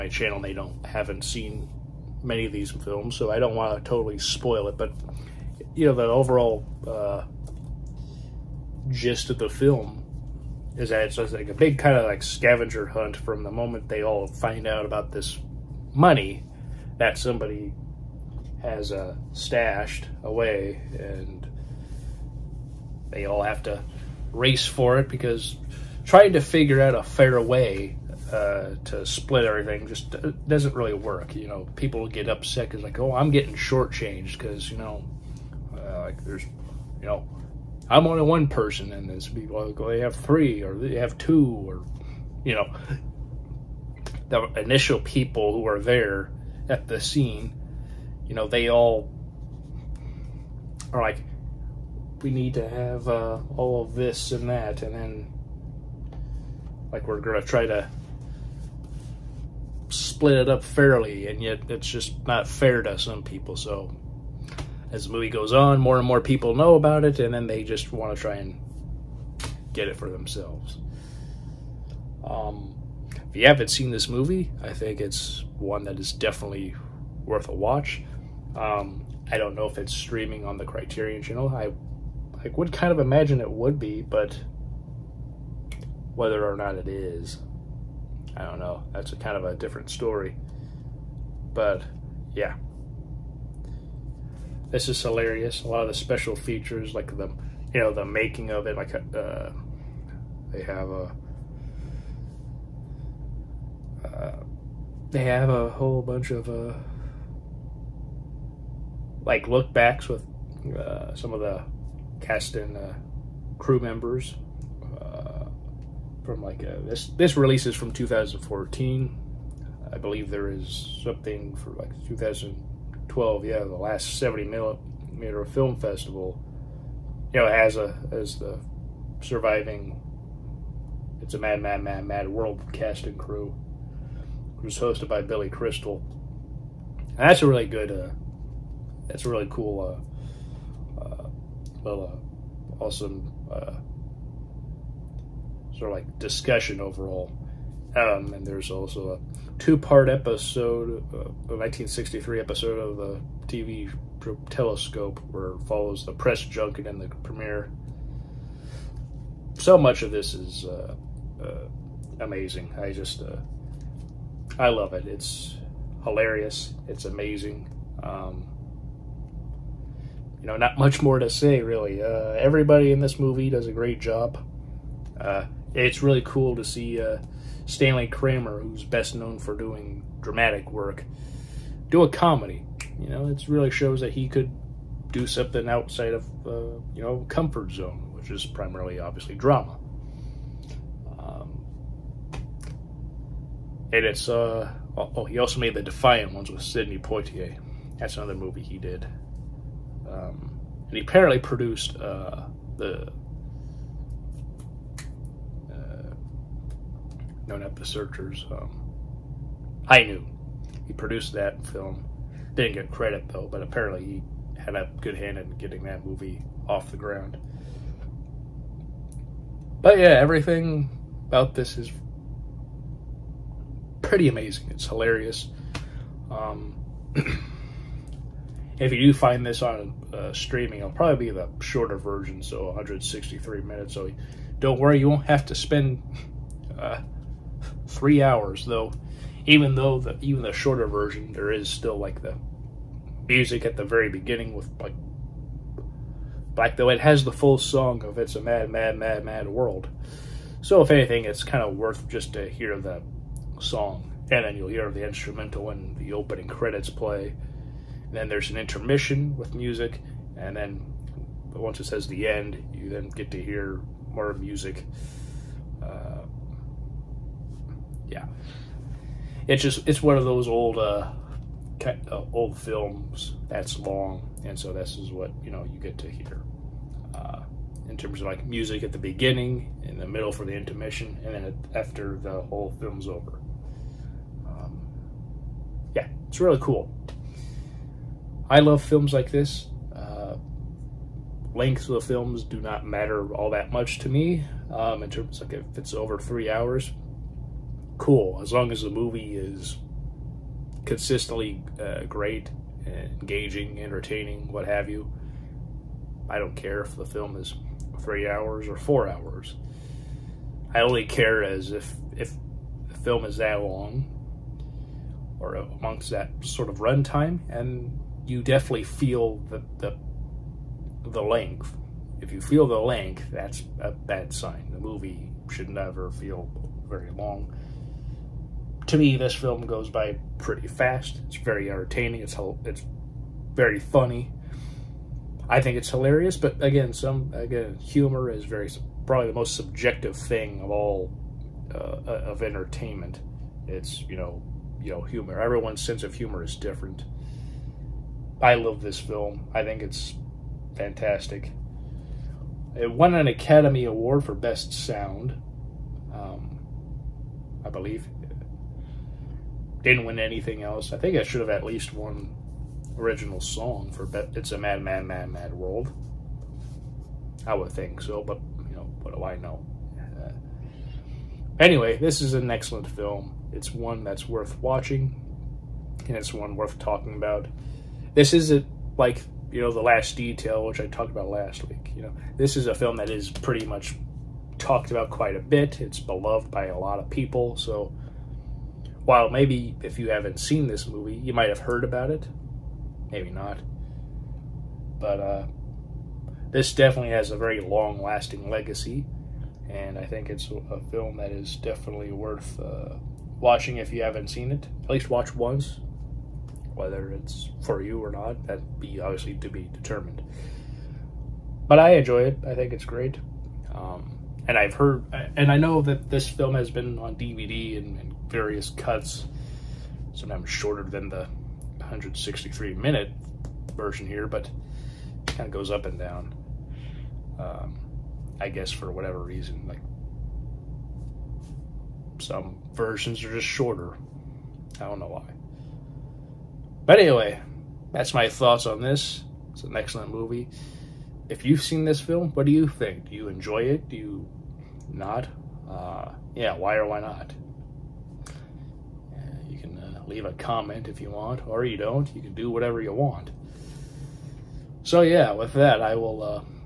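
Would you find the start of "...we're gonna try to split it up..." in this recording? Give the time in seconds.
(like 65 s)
57 s.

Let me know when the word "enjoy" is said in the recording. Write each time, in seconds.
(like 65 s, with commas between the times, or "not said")
411 s, 443 s.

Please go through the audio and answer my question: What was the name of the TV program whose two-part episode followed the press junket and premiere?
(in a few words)
Telescope.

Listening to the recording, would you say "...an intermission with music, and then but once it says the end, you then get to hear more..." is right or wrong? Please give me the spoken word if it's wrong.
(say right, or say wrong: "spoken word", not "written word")
right.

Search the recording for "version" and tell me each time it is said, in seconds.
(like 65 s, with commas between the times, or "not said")
231 s, 240 s, 423 s, 432 s.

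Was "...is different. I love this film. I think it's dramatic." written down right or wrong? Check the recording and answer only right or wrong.
wrong.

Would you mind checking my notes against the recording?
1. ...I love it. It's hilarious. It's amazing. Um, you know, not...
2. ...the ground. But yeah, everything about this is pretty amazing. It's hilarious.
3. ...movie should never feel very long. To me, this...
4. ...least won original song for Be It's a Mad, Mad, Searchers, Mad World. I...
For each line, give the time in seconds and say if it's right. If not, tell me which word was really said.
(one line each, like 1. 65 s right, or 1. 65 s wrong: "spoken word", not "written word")
1. 164 s right
2. 216 s right
3. 324 s right
4. 361 s wrong: "Mad", not "Searchers".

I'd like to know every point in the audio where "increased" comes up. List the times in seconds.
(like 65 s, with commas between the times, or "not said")
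not said.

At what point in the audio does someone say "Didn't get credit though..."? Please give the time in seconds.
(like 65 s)
212 s.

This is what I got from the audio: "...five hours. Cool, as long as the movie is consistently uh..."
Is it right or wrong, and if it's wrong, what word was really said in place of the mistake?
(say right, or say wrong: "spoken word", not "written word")
wrong: "three", not "five".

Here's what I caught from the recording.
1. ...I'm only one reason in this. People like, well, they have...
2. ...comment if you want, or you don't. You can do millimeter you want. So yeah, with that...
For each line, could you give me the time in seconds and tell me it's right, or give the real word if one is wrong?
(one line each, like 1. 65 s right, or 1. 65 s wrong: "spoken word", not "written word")
1. 37 s wrong: "person", not "reason"
2. 450 s wrong: "whatever", not "millimeter".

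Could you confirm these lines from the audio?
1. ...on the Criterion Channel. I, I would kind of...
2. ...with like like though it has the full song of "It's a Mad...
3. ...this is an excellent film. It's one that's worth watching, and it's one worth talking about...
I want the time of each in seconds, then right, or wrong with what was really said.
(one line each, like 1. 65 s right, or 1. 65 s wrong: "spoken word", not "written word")
1. 80 s right
2. 244 s right
3. 371 s right.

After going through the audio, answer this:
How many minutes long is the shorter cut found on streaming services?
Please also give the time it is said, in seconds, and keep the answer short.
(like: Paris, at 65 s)
163, at 232 s.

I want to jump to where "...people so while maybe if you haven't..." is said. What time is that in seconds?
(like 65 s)
387 s.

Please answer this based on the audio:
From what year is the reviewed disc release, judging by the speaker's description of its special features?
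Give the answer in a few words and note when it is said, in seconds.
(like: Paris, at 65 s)
2014, at 117 s.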